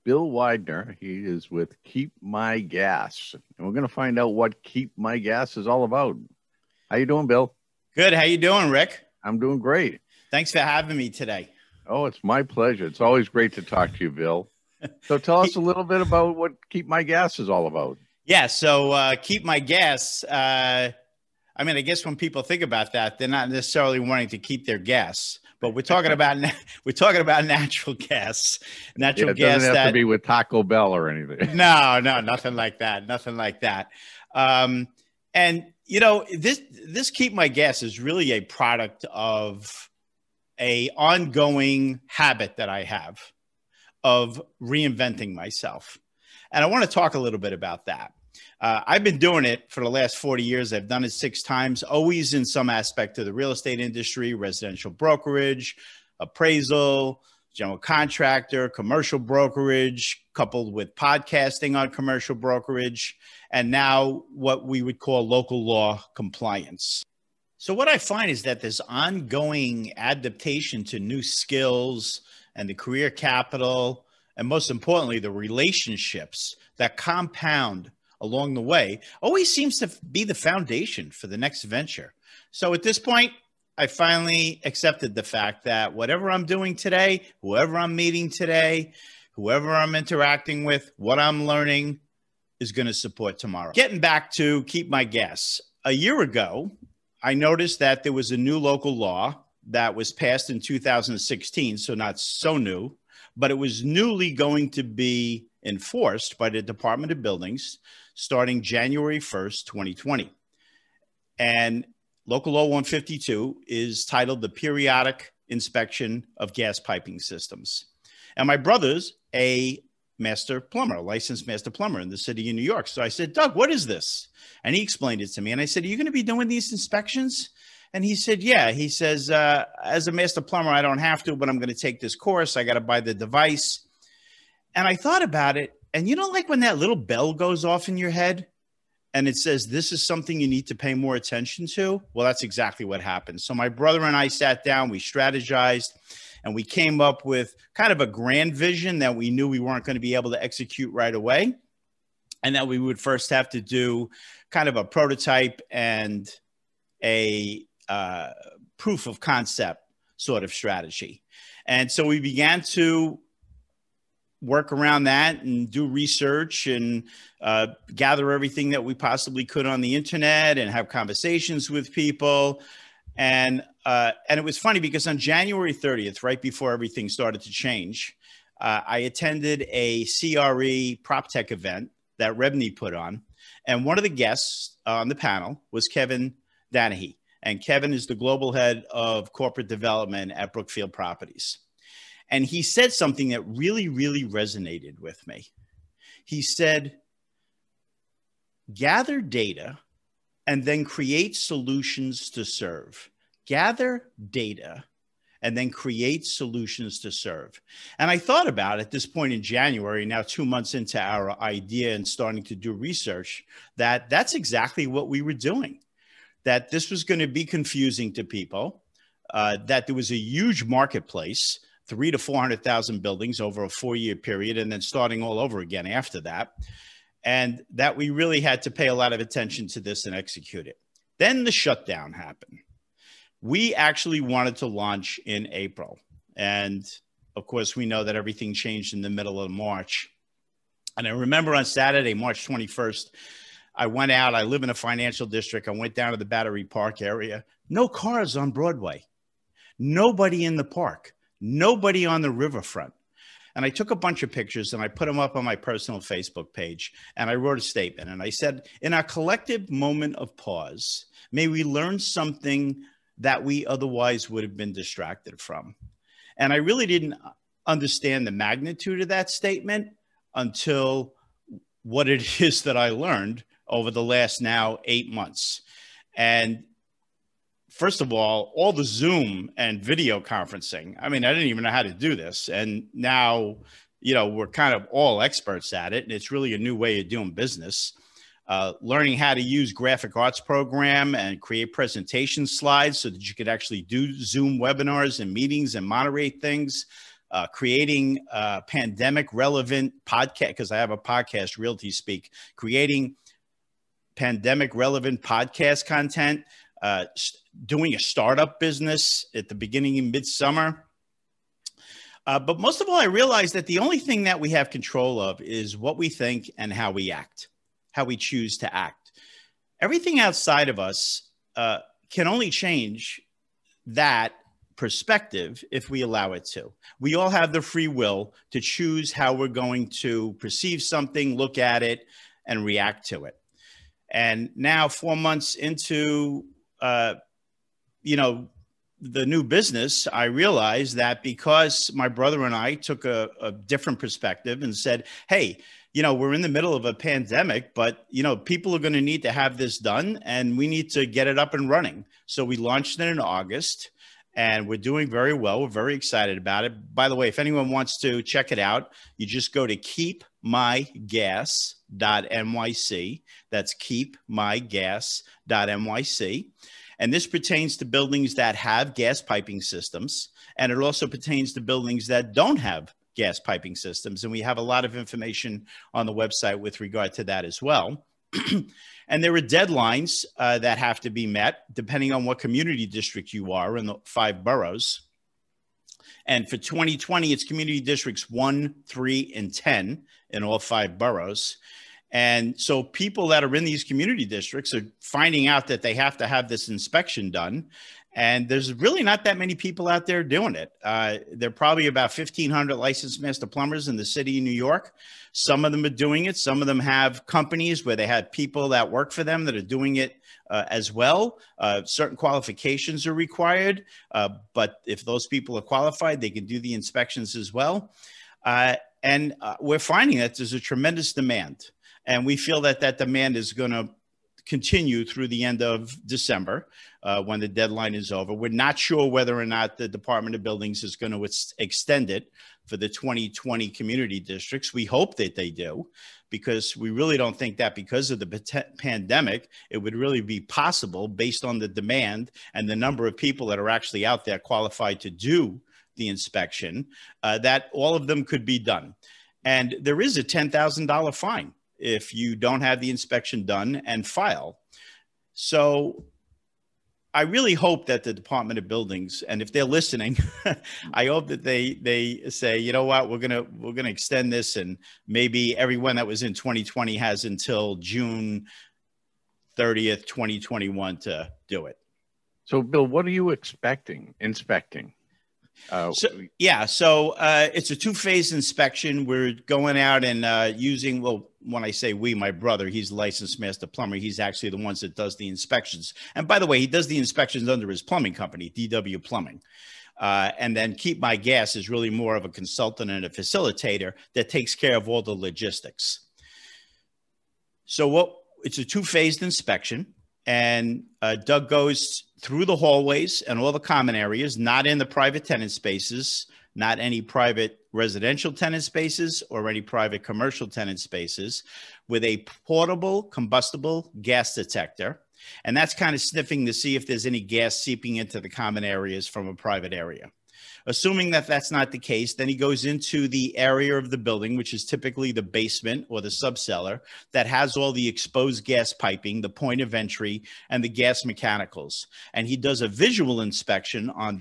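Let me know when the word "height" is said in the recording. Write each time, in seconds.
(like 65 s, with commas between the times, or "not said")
not said.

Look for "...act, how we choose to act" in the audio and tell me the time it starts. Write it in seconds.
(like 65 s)
317 s.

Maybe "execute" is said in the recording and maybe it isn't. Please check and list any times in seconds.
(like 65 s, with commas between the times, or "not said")
150 s, 230 s.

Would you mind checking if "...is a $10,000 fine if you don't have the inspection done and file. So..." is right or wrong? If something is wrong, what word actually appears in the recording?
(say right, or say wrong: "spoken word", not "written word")
right.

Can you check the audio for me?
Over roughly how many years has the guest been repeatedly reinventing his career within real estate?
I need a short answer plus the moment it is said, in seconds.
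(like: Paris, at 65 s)
40, at 50 s.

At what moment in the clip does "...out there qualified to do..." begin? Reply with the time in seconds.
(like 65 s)
444 s.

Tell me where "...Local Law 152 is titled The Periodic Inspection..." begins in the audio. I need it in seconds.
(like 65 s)
112 s.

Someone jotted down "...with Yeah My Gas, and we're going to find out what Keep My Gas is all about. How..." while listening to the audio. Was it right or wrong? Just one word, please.
wrong.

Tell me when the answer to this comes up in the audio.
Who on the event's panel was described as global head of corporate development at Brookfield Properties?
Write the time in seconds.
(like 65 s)
185 s.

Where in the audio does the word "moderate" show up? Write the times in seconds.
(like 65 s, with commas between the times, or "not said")
295 s.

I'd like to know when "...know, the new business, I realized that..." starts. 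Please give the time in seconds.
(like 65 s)
338 s.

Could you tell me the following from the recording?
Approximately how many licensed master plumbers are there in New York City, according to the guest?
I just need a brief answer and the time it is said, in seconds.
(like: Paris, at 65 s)
1,500, at 402 s.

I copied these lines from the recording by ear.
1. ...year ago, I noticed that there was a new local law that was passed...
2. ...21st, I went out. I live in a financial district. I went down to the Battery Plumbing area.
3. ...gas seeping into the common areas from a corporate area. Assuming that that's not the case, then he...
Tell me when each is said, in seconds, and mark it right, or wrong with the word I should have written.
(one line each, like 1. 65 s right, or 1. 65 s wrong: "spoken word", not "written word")
1. 95 s right
2. 242 s wrong: "Park", not "Plumbing"
3. 517 s wrong: "private", not "corporate".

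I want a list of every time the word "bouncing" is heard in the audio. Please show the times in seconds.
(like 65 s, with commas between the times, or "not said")
not said.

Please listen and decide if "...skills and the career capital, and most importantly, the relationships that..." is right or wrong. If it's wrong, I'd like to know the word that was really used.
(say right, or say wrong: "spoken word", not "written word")
right.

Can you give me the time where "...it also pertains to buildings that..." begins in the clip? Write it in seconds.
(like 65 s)
370 s.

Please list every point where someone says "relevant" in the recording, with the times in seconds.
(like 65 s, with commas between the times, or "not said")
299 s, 304 s.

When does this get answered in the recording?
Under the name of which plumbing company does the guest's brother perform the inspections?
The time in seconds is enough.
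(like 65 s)
488 s.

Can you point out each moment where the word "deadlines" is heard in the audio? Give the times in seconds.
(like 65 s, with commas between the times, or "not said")
379 s, 427 s.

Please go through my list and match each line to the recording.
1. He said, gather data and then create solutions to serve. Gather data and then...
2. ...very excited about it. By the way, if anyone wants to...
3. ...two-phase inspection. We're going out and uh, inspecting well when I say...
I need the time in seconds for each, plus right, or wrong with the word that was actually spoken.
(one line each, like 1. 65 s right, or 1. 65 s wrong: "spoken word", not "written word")
1. 196 s right
2. 355 s right
3. 477 s wrong: "using", not "inspecting".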